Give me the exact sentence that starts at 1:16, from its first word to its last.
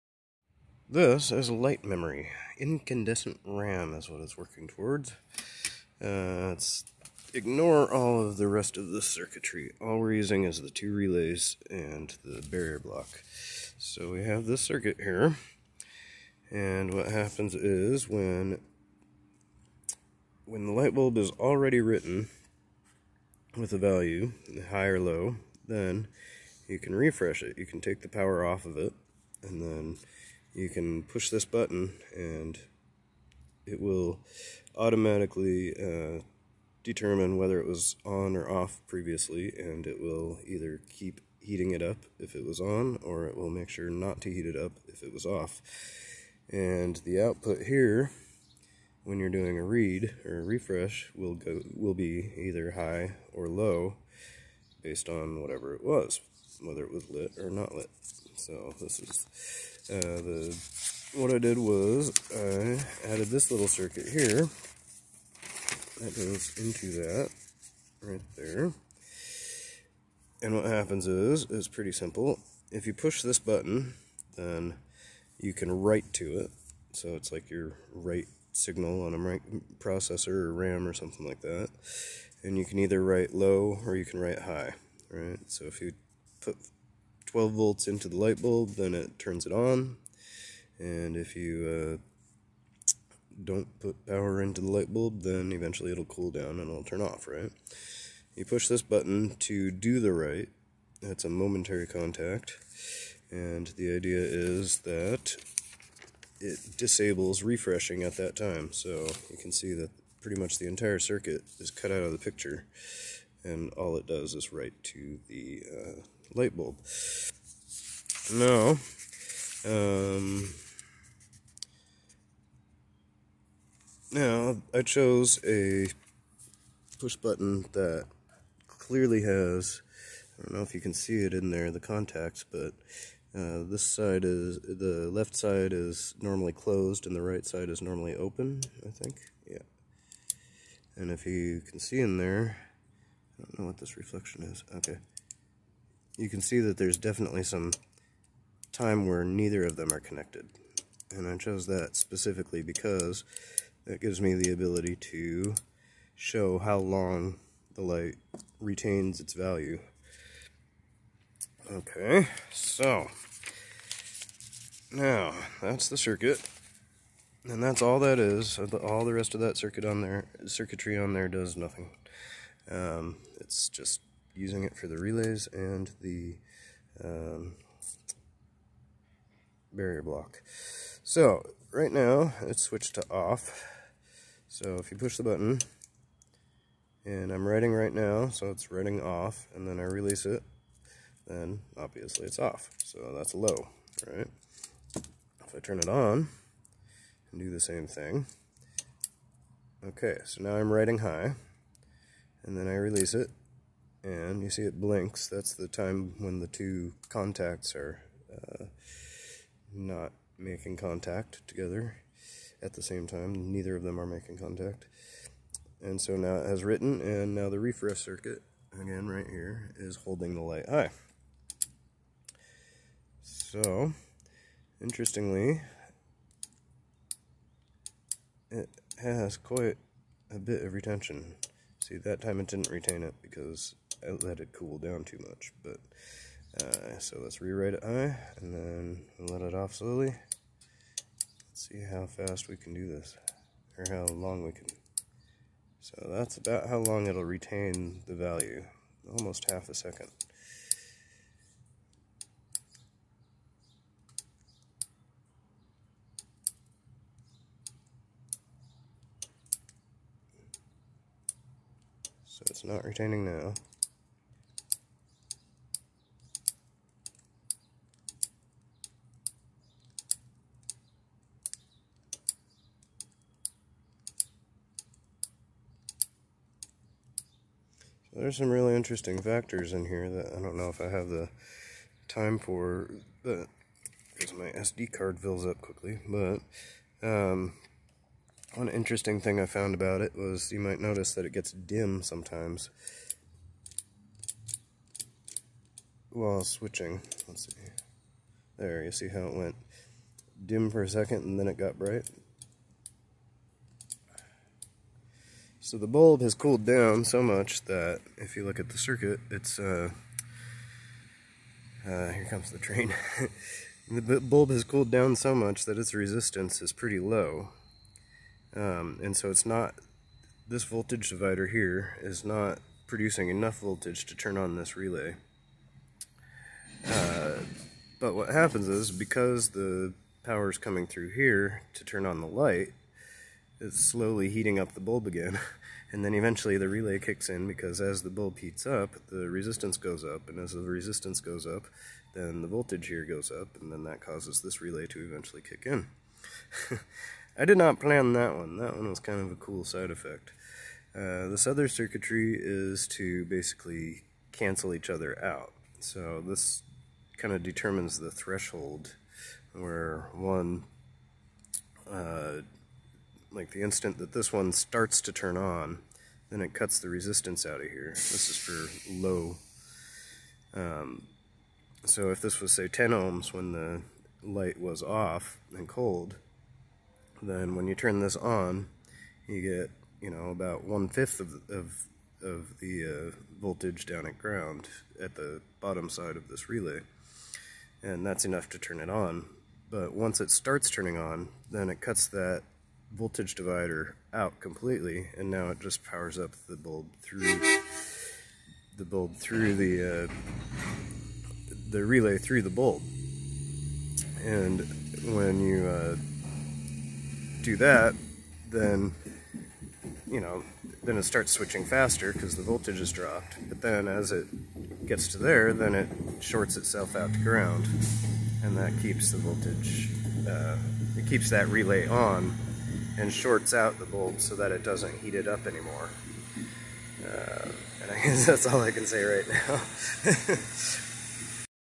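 So it's like your write signal on a processor or RAM or something like that.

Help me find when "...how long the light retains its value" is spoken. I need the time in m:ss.
2:36.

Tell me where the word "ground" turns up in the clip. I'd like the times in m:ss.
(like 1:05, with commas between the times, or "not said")
6:24, 6:57.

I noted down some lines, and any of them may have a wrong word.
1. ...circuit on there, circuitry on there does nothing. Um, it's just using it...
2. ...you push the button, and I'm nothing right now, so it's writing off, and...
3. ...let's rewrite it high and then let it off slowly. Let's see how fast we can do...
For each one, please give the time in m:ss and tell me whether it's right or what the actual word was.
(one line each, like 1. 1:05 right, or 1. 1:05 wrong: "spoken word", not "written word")
1. 2:49 right
2. 3:04 wrong: "writing", not "nothing"
3. 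3:57 right.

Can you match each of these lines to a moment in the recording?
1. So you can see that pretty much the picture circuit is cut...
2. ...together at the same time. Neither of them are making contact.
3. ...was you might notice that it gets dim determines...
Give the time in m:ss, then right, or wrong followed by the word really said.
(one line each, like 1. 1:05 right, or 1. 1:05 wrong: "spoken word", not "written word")
1. 1:48 wrong: "entire", not "picture"
2. 3:31 right
3. 4:50 wrong: "sometimes", not "determines".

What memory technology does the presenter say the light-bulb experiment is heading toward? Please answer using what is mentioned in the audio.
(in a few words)
Incandescent RAM.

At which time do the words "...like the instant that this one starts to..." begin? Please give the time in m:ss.
6:03.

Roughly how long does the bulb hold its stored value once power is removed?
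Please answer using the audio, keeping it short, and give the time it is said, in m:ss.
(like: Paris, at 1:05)
Almost half a second, at 4:09.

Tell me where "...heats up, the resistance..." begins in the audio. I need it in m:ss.
5:38.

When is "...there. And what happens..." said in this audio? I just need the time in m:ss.
1:08.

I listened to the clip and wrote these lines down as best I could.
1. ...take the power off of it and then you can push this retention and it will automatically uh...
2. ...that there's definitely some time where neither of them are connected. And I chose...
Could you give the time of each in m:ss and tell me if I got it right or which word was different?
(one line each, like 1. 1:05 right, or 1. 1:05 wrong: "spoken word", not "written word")
1. 0:27 wrong: "button", not "retention"
2. 2:26 right.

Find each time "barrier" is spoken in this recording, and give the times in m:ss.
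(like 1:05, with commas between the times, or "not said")
0:12, 2:59.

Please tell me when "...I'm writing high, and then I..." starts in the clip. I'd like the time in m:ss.
3:20.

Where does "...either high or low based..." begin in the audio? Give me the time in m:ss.
0:52.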